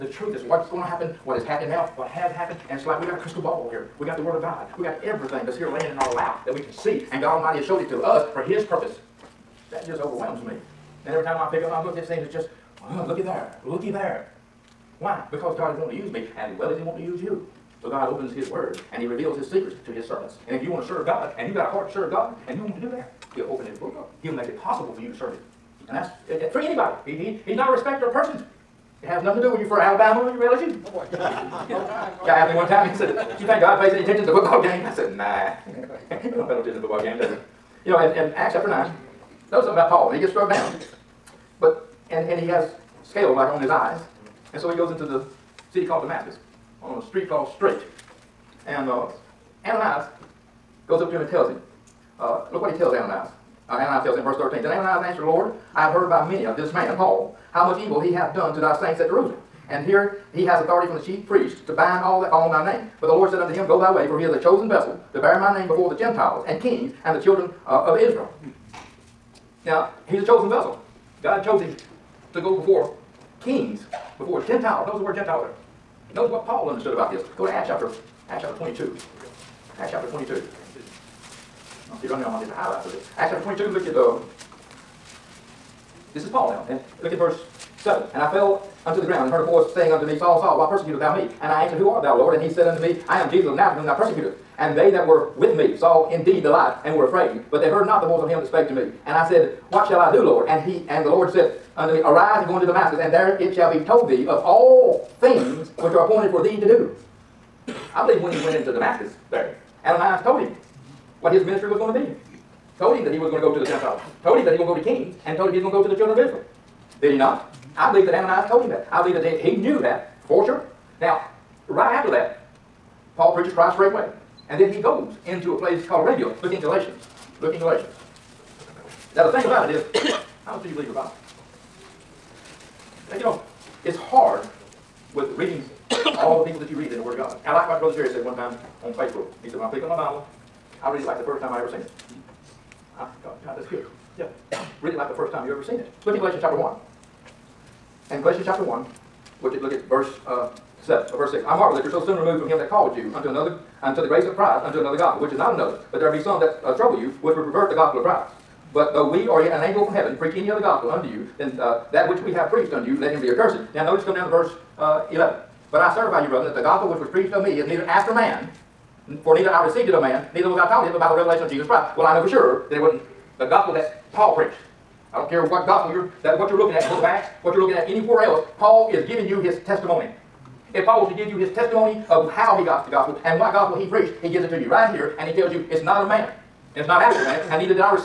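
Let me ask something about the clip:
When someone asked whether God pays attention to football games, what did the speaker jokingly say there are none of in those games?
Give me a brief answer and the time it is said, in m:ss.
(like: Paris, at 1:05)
Penalties, at 0:36.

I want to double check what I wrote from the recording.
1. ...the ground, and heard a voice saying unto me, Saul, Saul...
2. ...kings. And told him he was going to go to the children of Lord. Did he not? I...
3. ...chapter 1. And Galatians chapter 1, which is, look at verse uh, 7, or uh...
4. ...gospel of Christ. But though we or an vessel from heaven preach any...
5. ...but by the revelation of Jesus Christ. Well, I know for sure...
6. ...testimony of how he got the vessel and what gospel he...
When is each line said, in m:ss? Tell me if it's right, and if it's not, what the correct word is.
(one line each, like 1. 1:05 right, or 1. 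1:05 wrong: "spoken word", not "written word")
1. 1:29 right
2. 1:54 wrong: "Israel", not "Lord"
3. 2:26 right
4. 2:37 wrong: "angel", not "vessel"
5. 2:50 right
6. 3:01 wrong: "gospel", not "vessel".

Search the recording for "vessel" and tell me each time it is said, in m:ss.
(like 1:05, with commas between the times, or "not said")
1:04, 1:10.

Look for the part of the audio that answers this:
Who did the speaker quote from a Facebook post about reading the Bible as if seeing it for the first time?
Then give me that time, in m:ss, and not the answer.
2:17.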